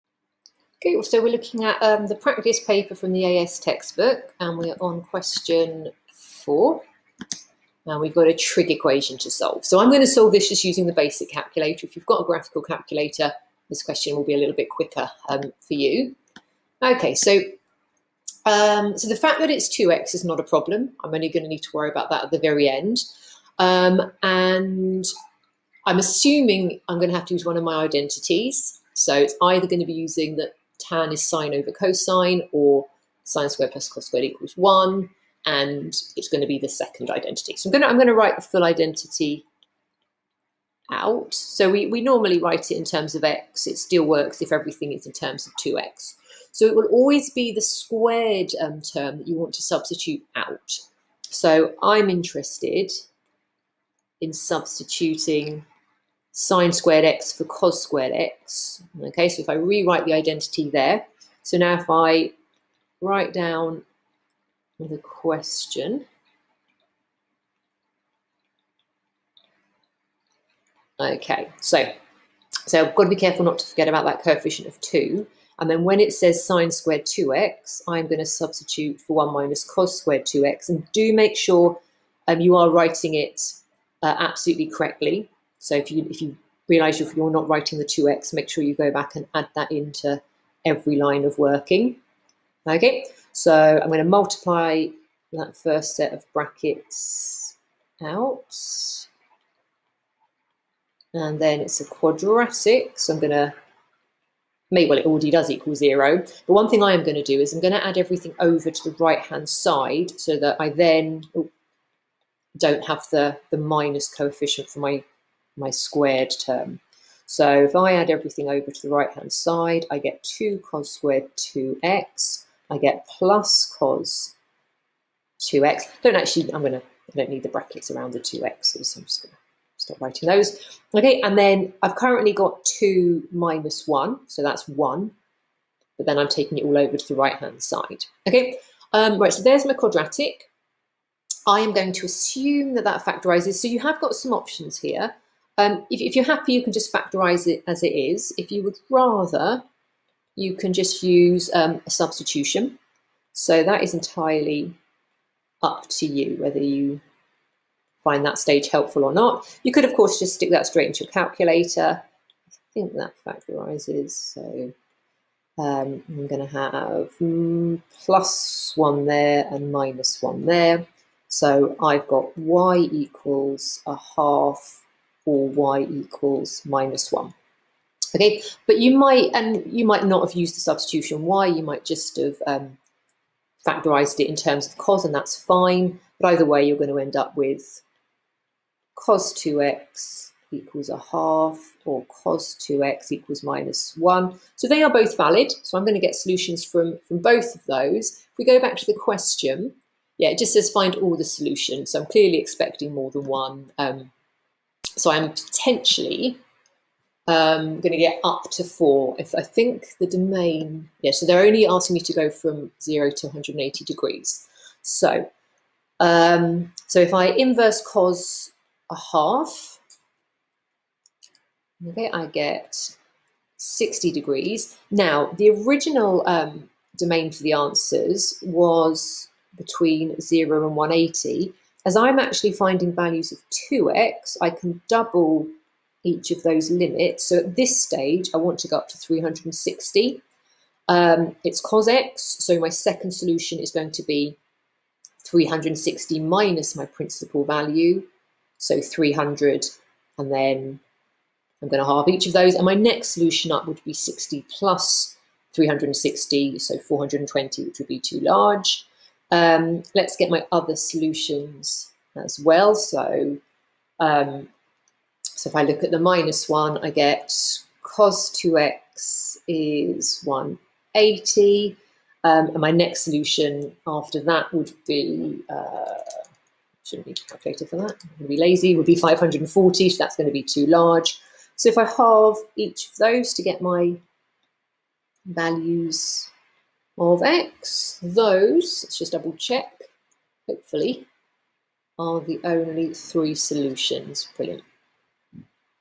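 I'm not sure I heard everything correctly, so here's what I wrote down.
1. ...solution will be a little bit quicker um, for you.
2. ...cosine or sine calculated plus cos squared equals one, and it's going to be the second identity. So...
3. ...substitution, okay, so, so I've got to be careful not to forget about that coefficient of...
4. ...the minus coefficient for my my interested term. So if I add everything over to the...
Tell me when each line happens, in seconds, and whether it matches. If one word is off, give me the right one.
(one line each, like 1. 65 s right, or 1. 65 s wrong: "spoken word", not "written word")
1. 13 s wrong: "question", not "solution"
2. 31 s wrong: "squared", not "calculated"
3. 64 s wrong: "question", not "substitution"
4. 113 s wrong: "squared", not "interested".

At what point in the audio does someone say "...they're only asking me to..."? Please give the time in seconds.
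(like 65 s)
211 s.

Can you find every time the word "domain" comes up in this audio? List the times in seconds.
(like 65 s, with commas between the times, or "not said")
210 s, 226 s.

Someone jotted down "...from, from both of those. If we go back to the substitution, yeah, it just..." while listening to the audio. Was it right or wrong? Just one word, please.
wrong.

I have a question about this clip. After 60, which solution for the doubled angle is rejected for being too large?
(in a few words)
420.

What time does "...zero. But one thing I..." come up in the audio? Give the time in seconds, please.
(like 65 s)
105 s.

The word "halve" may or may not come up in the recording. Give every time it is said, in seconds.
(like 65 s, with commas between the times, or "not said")
251 s, 281 s.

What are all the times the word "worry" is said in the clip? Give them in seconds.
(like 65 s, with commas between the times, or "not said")
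21 s.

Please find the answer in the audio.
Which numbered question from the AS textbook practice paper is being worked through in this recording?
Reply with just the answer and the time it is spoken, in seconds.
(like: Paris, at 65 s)
Question 4, at 5 s.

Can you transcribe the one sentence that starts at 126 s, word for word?
Don't actually, I'm going to, I don't need the brackets around the 2x's, so I'm just going to stop writing those.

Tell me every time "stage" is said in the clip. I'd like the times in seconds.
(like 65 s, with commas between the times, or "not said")
158 s, 237 s.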